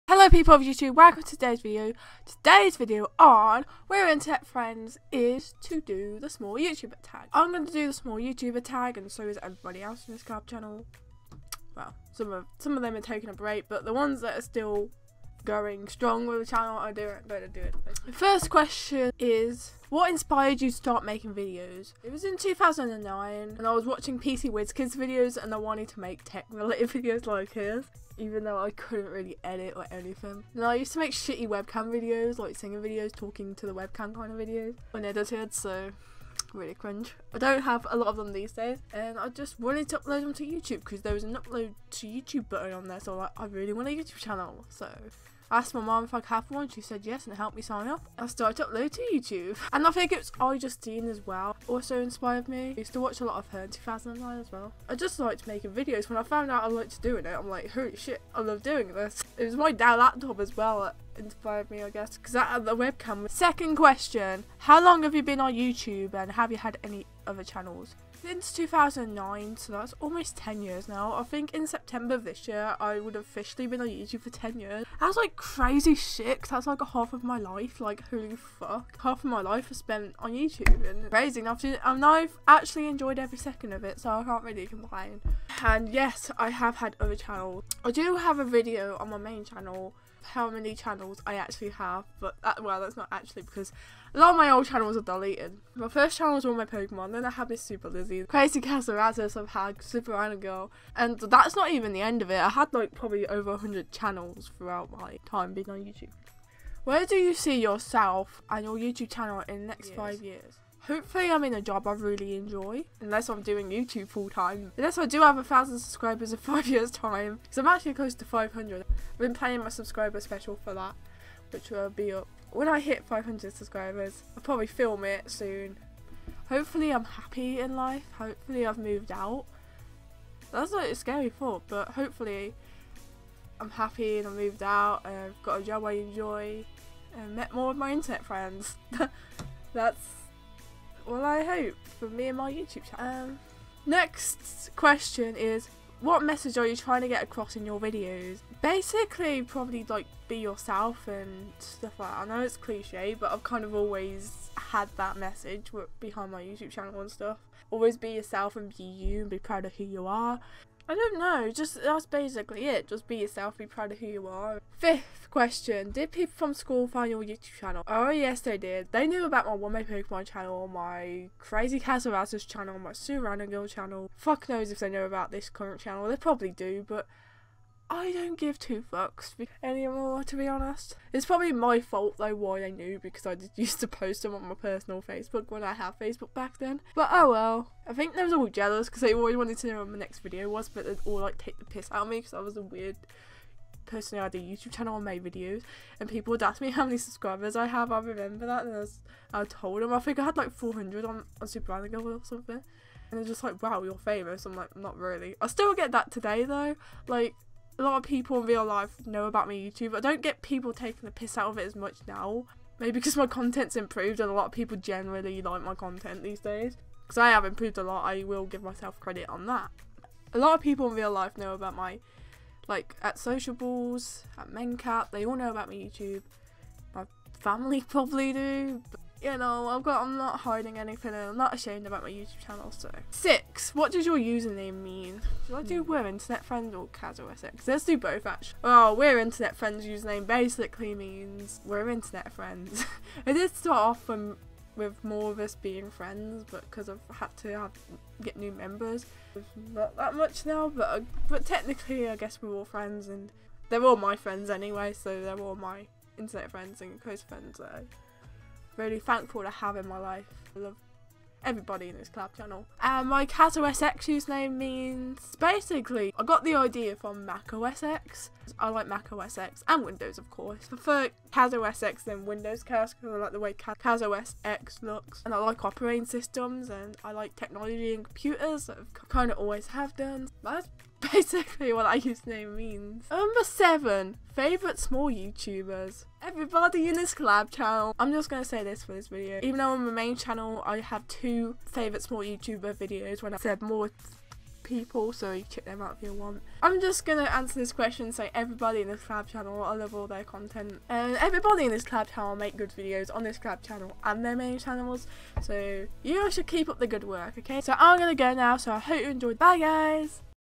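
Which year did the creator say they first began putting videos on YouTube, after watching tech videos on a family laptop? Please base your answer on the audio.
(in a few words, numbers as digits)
2009.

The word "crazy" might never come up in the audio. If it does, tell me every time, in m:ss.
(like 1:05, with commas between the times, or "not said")
1:15, 1:21, 1:38, 2:51.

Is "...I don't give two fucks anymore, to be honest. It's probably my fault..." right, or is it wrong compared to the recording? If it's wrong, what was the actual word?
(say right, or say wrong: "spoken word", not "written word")
right.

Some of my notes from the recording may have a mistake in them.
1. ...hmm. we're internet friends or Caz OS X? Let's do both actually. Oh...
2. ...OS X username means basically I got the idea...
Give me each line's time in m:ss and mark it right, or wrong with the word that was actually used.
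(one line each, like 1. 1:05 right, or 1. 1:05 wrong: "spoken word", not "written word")
1. 3:55 right
2. 4:23 right.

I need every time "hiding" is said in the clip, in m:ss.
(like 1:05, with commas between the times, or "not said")
3:50.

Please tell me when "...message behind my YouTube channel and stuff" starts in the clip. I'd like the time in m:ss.
2:35.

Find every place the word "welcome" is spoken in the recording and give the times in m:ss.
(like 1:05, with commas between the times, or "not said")
0:00.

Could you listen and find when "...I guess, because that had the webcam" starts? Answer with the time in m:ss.
1:01.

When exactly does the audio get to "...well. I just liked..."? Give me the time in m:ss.
0:54.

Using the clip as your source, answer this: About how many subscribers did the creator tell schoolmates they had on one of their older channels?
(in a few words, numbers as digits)
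400.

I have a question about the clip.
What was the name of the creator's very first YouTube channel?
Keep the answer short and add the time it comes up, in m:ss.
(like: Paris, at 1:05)
all my Pokemon, at 1:36.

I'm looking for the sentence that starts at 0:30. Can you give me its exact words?
And I used to make shitty webcam videos like singing videos, talking to the webcam kind of videos unedited so really cringe.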